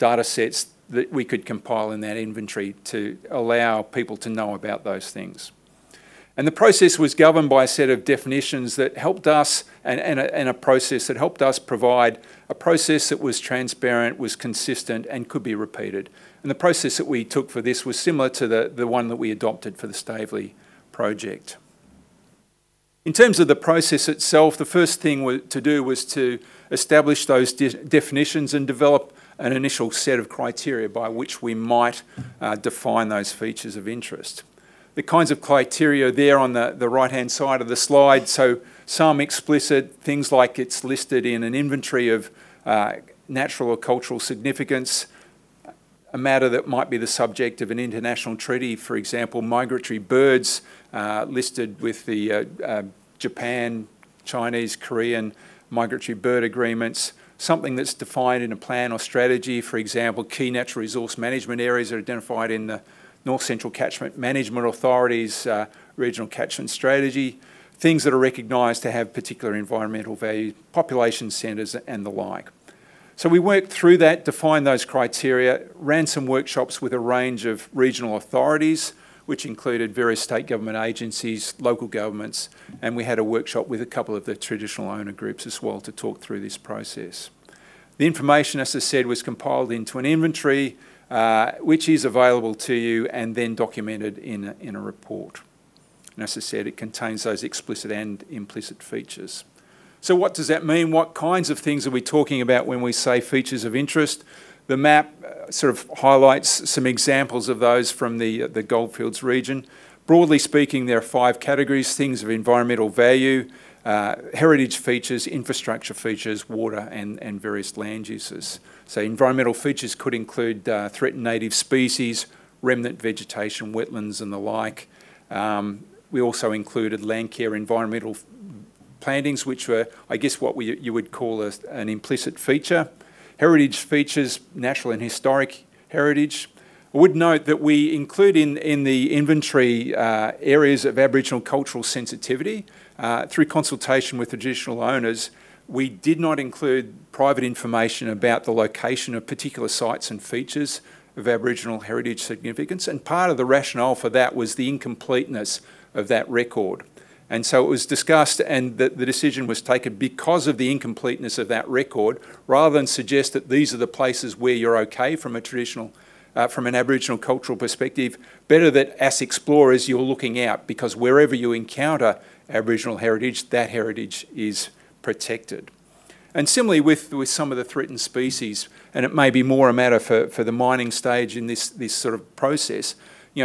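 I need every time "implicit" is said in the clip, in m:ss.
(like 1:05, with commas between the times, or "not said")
1:38, 2:11.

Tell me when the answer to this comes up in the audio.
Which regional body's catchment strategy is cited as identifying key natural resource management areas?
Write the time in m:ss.
1:03.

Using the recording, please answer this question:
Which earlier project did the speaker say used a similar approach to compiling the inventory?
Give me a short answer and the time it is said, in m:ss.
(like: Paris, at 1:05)
Staveley project, at 0:19.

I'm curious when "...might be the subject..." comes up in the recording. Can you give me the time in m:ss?
0:46.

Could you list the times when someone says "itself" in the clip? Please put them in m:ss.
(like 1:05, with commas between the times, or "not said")
0:24.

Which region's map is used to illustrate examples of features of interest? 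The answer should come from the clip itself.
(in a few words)
Goldfields.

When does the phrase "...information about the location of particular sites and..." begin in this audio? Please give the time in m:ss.
2:27.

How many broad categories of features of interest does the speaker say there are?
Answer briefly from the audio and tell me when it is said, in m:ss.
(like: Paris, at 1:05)
5, at 1:51.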